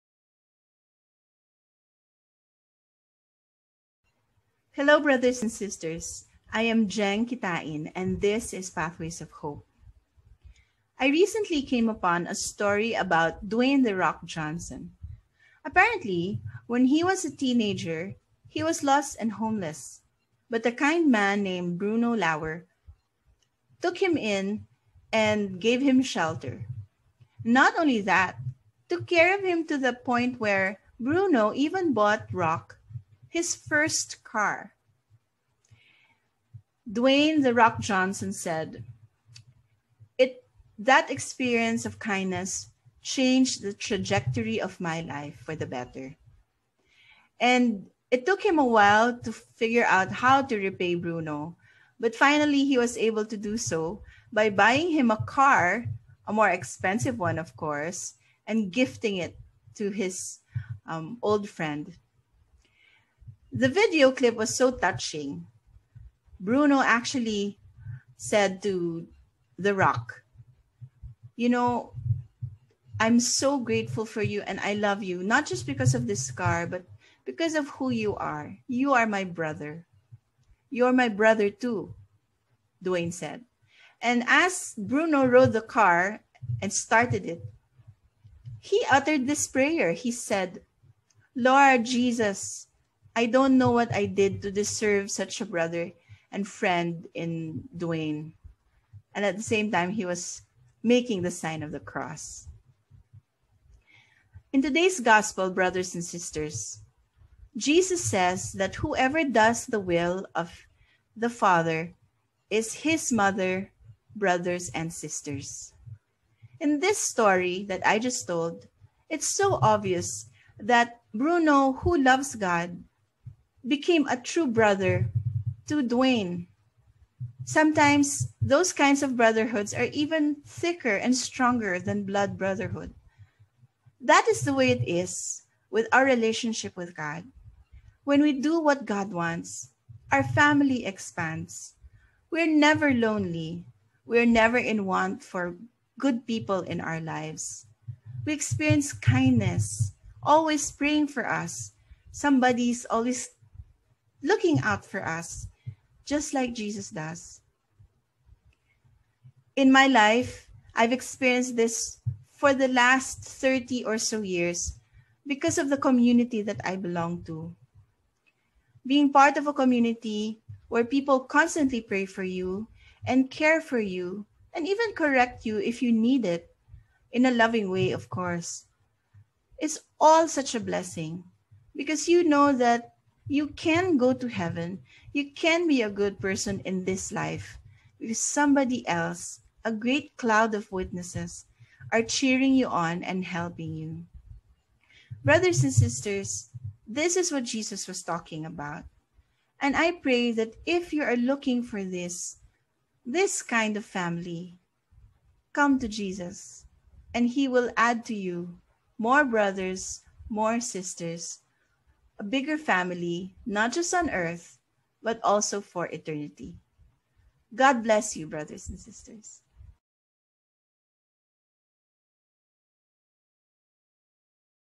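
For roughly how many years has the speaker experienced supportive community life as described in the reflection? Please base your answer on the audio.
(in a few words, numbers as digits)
30.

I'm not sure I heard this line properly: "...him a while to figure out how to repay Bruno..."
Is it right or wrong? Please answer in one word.
right.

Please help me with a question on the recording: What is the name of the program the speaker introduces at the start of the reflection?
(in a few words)
Pathways of Hope.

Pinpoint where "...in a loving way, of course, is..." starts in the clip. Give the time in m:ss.
2:57.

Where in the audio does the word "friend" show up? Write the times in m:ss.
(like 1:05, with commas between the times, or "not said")
1:01, 1:36.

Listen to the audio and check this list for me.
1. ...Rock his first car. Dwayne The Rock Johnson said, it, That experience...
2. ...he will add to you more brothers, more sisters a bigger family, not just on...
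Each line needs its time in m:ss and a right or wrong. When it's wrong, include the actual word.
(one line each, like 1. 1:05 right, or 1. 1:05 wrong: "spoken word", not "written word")
1. 0:32 right
2. 3:27 right.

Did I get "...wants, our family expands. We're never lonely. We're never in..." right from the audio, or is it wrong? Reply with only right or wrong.
right.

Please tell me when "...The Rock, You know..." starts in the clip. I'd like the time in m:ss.
1:09.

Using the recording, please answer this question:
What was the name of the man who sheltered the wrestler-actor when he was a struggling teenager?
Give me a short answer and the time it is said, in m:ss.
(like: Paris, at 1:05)
Bruno Lauer, at 0:21.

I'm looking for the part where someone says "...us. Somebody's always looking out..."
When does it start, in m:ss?
2:31.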